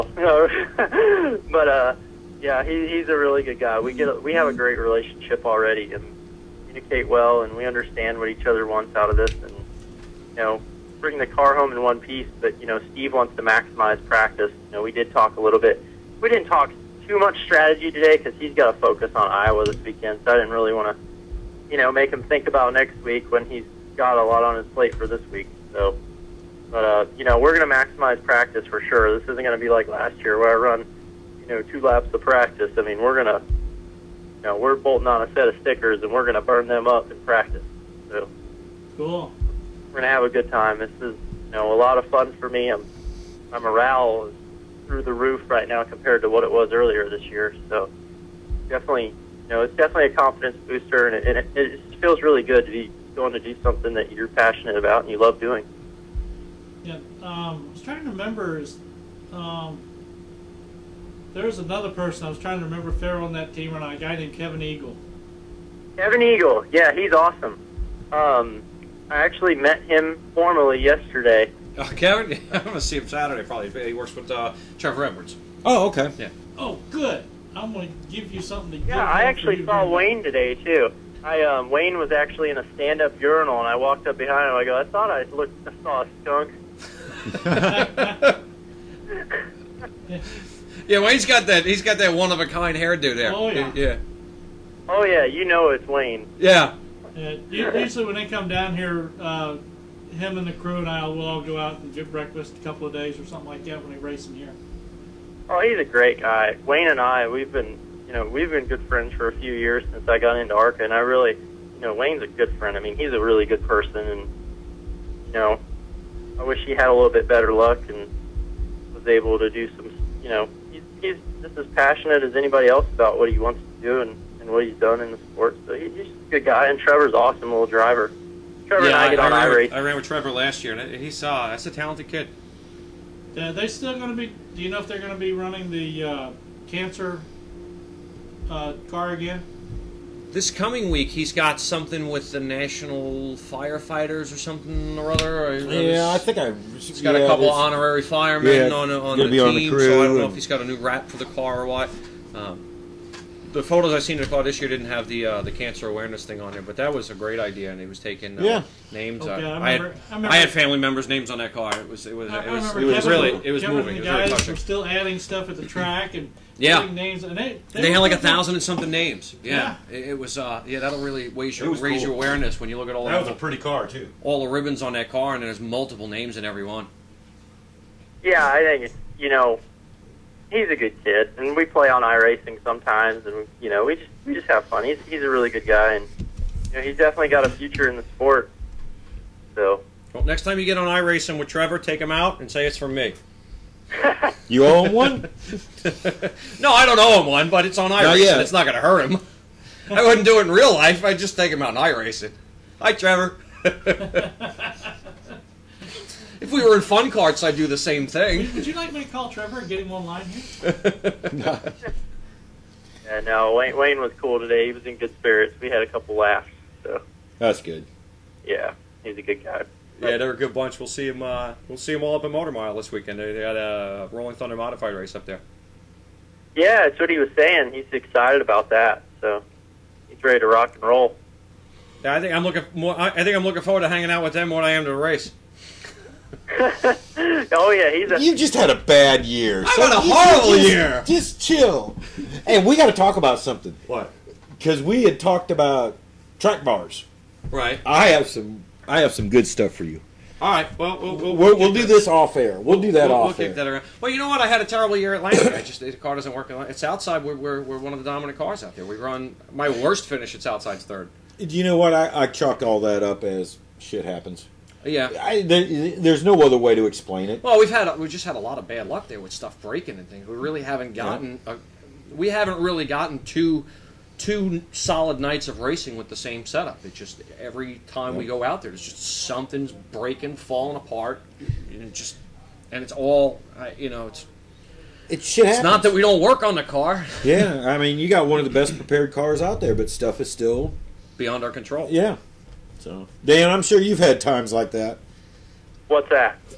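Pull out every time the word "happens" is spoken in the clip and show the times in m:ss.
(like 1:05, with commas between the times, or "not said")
4:24, 4:45.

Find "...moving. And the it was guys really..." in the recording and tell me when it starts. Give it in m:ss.
2:43.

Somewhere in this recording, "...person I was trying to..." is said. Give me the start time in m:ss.
1:01.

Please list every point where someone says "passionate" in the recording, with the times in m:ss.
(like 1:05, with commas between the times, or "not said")
0:54, 2:01.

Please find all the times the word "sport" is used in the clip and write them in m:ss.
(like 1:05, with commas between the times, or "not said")
2:05, 3:08.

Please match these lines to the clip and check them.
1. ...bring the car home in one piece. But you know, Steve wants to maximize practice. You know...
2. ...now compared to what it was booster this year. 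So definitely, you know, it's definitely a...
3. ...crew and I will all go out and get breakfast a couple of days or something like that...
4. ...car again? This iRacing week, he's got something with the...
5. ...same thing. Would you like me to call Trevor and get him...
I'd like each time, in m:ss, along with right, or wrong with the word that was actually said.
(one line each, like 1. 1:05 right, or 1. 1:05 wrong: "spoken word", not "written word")
1. 0:10 right
2. 0:45 wrong: "earlier", not "booster"
3. 1:40 right
4. 2:18 wrong: "coming", not "iRacing"
5. 3:27 right.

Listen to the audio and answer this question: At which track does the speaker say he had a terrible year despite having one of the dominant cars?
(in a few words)
Langley.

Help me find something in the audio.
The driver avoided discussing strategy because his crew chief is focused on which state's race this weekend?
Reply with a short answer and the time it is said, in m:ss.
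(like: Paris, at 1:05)
Iowa, at 0:19.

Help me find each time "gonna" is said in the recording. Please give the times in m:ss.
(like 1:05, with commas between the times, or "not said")
1:12, 1:17.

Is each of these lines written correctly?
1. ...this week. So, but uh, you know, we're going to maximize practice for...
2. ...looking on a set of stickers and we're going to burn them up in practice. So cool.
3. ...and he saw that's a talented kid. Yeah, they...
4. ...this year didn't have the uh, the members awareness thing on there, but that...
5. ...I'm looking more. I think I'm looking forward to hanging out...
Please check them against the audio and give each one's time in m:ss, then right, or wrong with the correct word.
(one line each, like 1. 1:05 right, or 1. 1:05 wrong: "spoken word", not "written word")
1. 0:25 right
2. 0:34 wrong: "bolting", not "looking"
3. 2:10 right
4. 2:34 wrong: "cancer", not "members"
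5. 3:52 right.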